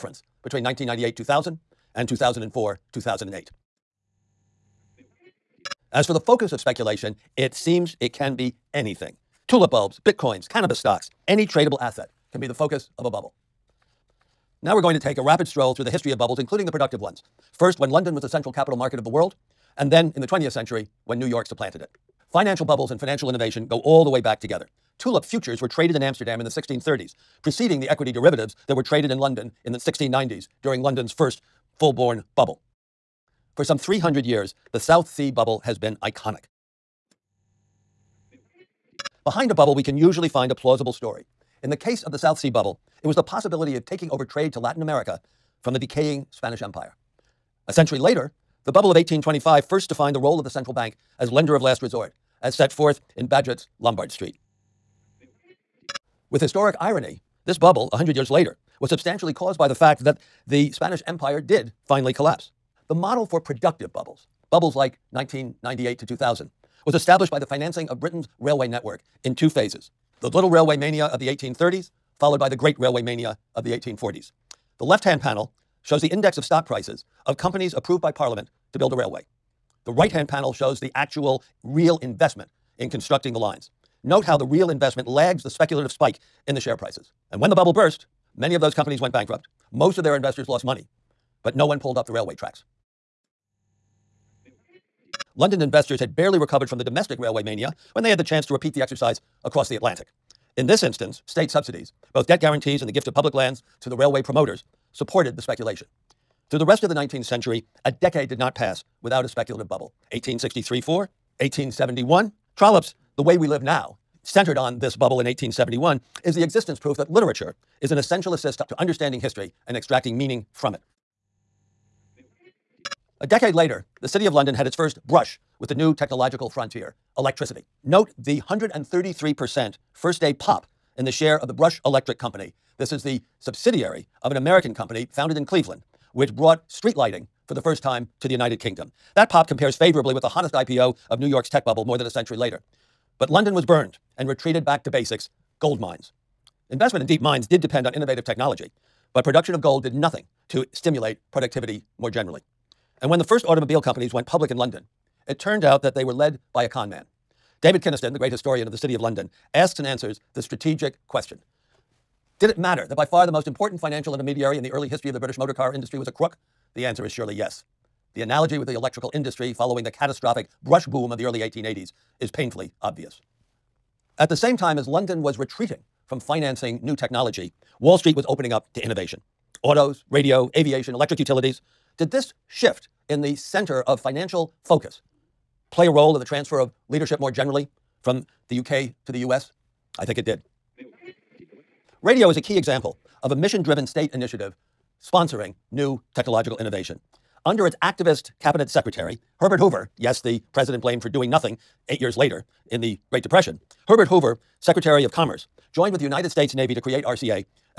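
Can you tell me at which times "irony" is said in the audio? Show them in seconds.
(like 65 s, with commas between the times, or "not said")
56 s.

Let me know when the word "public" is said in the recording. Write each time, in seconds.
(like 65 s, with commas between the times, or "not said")
103 s, 154 s.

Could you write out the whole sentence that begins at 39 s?
Behind a bubble, we can usually find a plausible story.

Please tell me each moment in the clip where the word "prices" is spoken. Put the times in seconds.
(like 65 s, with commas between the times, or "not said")
76 s, 86 s.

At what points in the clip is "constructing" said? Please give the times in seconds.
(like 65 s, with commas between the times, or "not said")
82 s.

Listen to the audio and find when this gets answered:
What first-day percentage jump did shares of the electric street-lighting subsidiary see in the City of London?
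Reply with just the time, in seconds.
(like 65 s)
128 s.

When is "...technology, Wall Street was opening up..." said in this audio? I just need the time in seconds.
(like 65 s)
176 s.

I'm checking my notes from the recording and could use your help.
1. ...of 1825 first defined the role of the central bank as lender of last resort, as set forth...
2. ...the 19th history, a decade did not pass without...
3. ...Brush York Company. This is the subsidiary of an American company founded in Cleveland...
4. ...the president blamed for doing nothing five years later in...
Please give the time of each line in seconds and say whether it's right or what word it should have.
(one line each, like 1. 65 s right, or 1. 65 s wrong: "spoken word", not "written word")
1. 48 s right
2. 106 s wrong: "century", not "history"
3. 131 s wrong: "Electric", not "York"
4. 200 s wrong: "eight", not "five".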